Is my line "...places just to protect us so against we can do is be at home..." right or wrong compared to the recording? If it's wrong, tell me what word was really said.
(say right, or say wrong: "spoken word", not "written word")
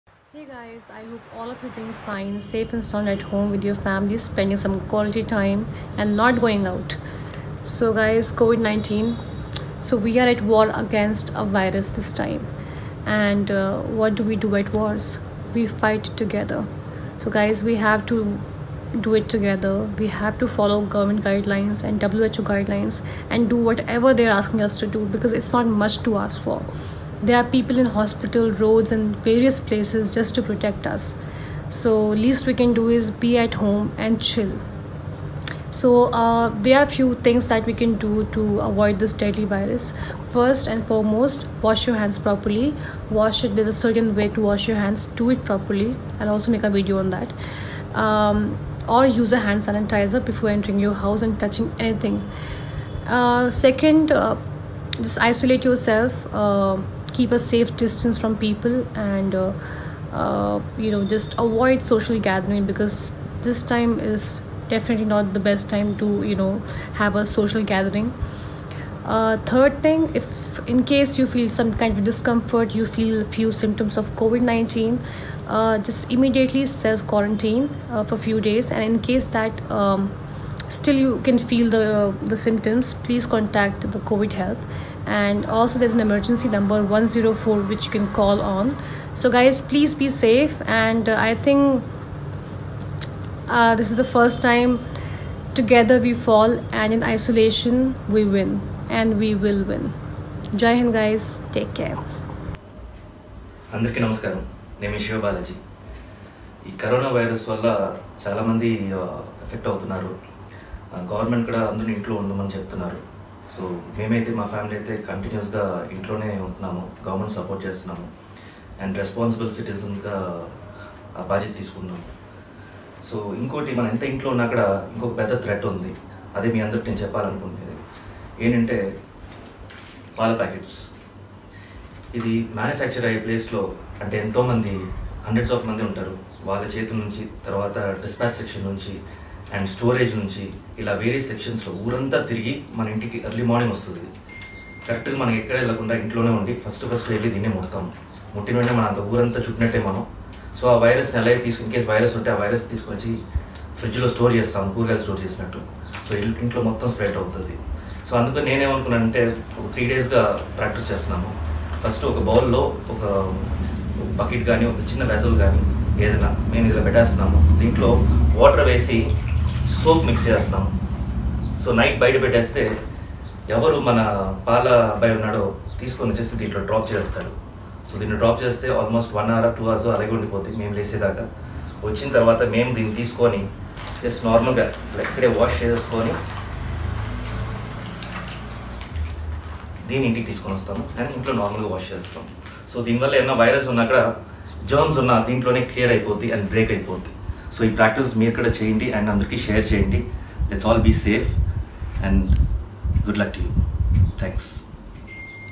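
wrong: "least", not "against".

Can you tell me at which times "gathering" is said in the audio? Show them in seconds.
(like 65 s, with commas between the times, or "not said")
62 s, 67 s.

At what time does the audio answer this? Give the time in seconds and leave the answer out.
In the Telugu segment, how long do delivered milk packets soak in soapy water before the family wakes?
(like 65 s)
179 s.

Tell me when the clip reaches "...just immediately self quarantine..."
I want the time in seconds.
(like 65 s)
75 s.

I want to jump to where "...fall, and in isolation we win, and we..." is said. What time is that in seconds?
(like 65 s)
96 s.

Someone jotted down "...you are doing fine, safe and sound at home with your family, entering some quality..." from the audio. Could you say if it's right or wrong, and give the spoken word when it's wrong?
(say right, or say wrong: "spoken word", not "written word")
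wrong: "spending", not "entering".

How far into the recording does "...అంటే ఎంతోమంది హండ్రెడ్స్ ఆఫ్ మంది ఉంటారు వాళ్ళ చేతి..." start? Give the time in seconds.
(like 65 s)
134 s.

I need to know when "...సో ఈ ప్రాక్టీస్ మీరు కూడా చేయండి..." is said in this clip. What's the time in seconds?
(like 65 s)
197 s.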